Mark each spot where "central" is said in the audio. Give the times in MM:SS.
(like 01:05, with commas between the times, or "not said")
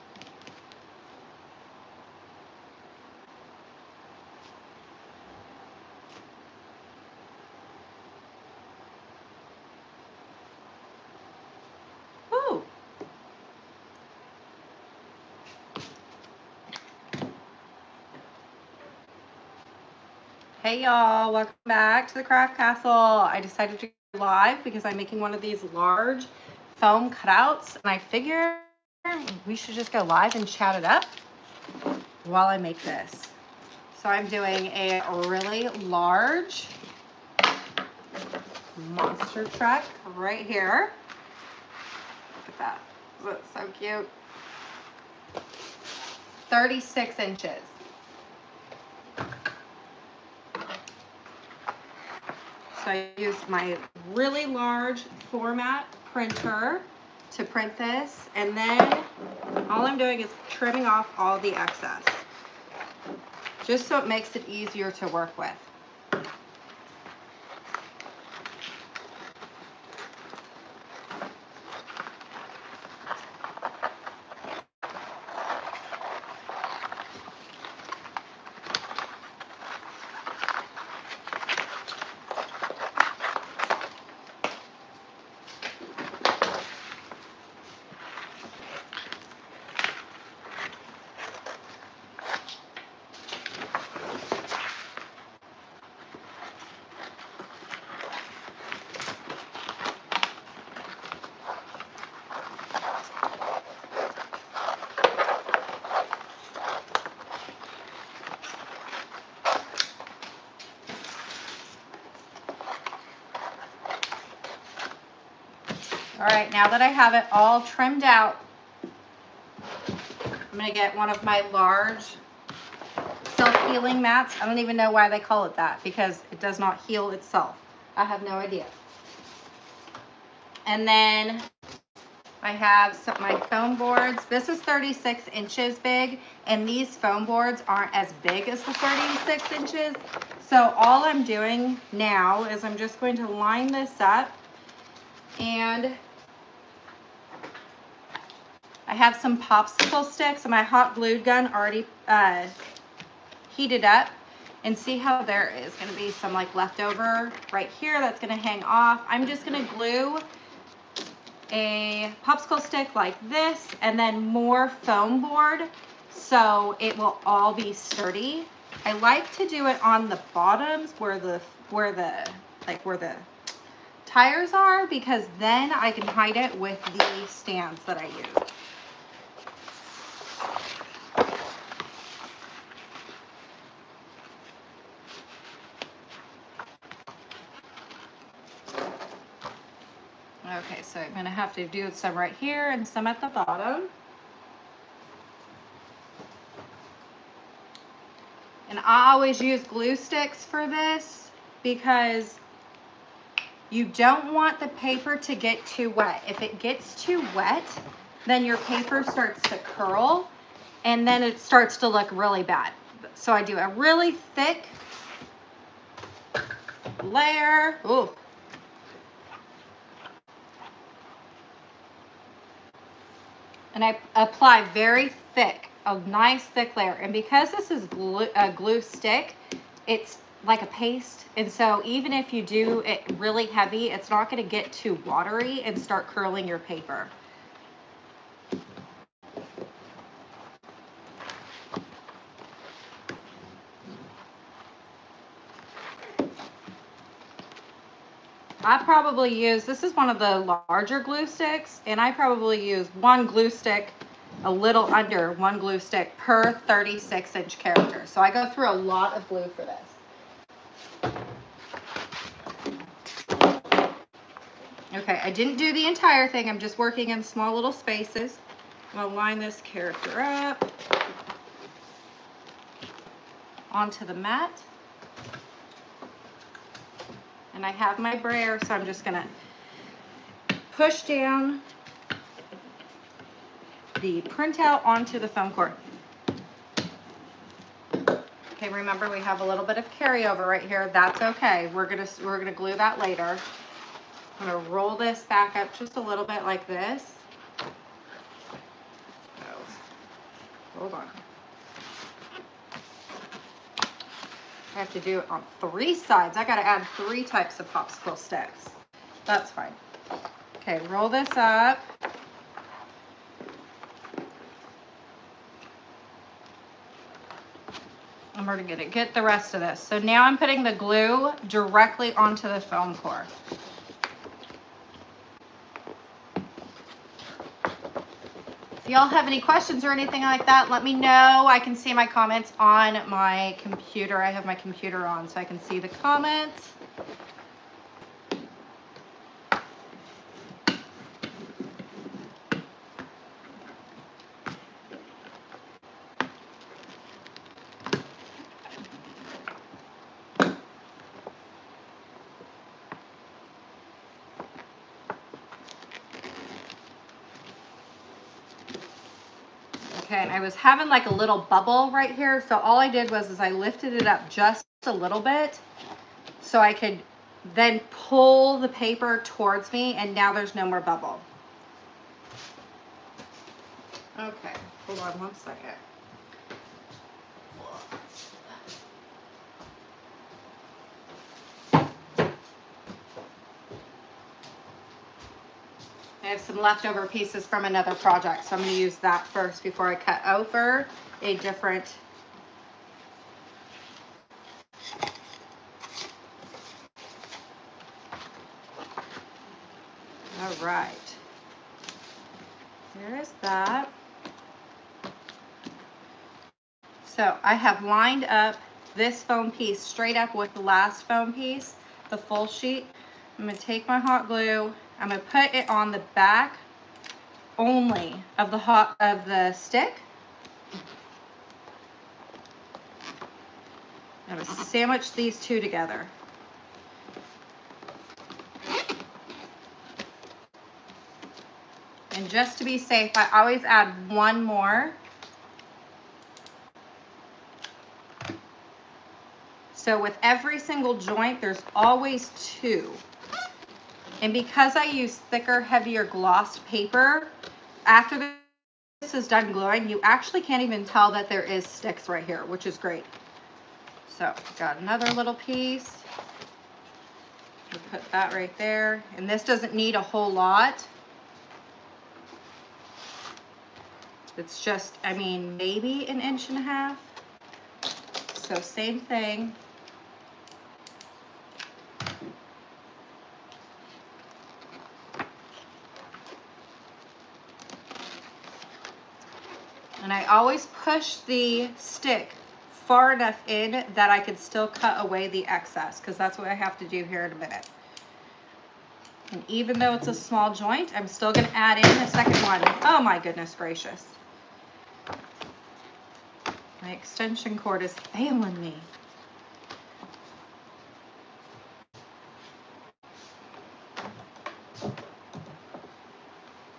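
not said.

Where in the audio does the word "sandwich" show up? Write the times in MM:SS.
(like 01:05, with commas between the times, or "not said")
07:04.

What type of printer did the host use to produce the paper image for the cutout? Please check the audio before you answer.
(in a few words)
Large format printer.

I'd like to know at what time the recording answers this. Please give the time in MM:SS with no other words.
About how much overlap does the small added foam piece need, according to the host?
07:46.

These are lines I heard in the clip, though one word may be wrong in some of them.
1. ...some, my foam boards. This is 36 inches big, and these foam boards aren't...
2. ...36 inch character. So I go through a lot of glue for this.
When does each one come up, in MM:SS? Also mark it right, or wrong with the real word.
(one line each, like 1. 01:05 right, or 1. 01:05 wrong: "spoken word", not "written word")
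1. 02:12 right
2. 04:16 right.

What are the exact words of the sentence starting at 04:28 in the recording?
I'm gonna line this character up onto the mat.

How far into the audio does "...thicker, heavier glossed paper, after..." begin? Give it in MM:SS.
07:25.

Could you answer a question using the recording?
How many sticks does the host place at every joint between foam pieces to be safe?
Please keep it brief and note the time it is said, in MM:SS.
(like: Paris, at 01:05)
2, at 07:21.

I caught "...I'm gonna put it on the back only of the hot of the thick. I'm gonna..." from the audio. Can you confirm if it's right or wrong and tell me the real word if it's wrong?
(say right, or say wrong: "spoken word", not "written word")
wrong: "stick", not "thick".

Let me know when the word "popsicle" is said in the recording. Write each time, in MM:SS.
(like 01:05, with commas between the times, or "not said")
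02:29, 02:42, 05:07.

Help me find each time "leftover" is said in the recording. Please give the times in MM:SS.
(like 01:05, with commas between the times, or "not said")
02:36, 06:26.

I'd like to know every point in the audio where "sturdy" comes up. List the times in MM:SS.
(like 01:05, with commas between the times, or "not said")
02:47.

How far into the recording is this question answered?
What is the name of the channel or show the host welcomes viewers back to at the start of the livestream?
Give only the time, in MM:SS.
00:22.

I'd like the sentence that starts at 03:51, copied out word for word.
And so even if you do it really heavy, it's not gonna get too watery and start curling your paper.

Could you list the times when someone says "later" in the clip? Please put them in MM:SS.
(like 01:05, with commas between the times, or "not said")
04:52.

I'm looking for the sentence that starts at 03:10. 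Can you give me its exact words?
So I'm gonna have to do some right here and some at the bottom.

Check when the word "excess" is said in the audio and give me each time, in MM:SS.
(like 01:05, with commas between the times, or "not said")
01:01, 08:05.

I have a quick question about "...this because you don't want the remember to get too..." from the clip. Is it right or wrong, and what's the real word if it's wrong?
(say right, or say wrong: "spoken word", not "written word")
wrong: "paper", not "remember".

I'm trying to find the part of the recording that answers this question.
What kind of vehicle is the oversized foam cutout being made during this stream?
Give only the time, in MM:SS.
00:38.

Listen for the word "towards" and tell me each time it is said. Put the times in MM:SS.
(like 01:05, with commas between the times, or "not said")
06:09.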